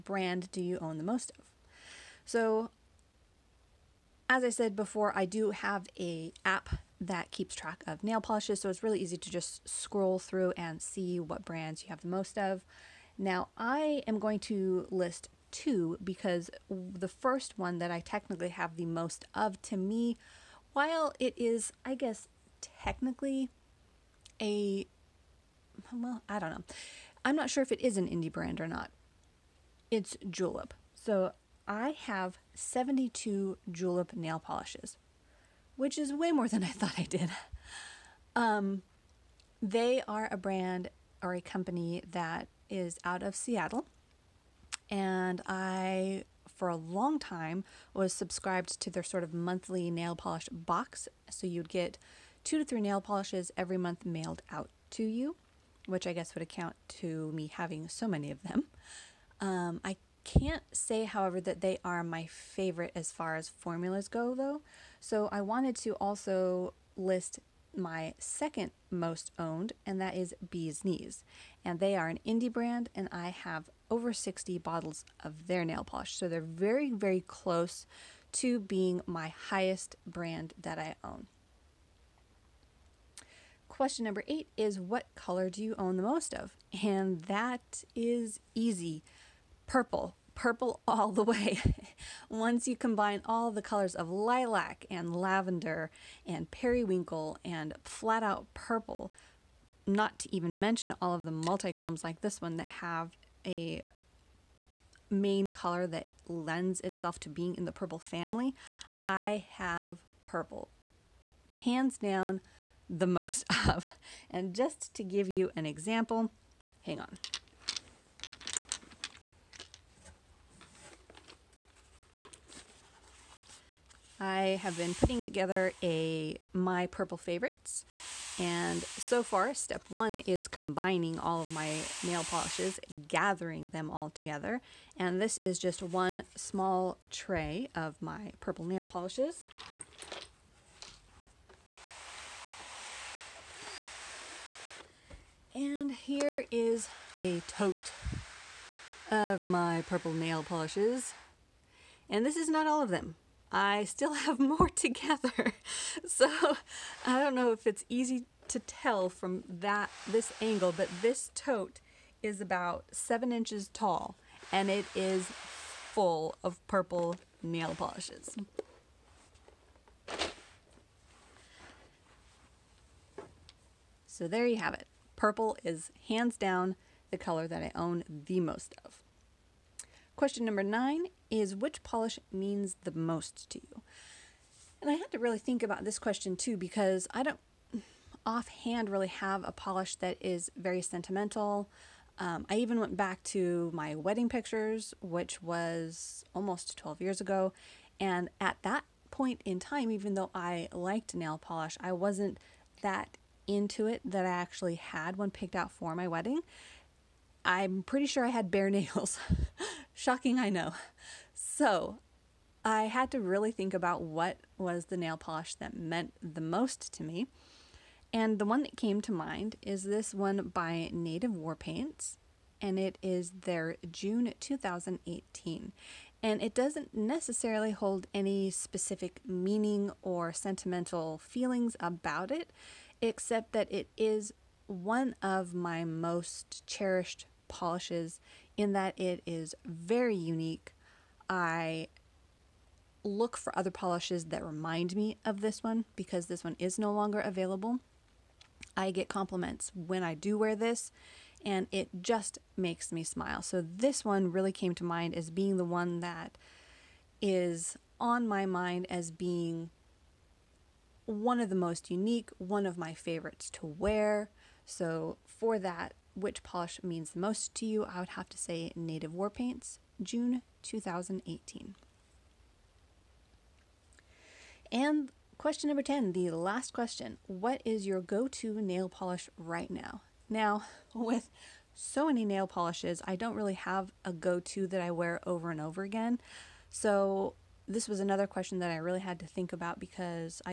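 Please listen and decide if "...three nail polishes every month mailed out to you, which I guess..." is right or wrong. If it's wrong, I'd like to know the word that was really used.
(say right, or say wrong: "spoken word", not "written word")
right.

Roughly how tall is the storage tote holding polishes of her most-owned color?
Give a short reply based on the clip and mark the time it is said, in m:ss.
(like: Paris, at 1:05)
7 inches, at 2:42.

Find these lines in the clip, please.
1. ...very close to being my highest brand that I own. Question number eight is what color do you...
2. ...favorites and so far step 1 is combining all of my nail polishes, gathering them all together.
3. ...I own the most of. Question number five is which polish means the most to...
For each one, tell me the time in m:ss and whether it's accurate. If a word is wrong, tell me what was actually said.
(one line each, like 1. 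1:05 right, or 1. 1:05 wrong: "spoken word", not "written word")
1. 1:16 right
2. 2:07 right
3. 2:57 wrong: "nine", not "five".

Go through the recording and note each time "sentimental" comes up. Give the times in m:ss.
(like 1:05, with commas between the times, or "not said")
3:10, 3:50.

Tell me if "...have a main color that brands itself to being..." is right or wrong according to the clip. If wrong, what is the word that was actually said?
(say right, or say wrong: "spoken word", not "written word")
wrong: "lends", not "brands".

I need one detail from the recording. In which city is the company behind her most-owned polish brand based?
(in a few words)
Seattle.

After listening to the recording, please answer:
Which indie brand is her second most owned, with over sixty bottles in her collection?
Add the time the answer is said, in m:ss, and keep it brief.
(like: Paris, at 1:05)
Bee's Knees, at 1:10.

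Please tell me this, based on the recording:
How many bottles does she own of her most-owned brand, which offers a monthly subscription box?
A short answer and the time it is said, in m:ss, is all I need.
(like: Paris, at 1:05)
72, at 0:32.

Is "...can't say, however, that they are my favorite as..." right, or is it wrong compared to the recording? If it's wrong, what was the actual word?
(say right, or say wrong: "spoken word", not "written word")
right.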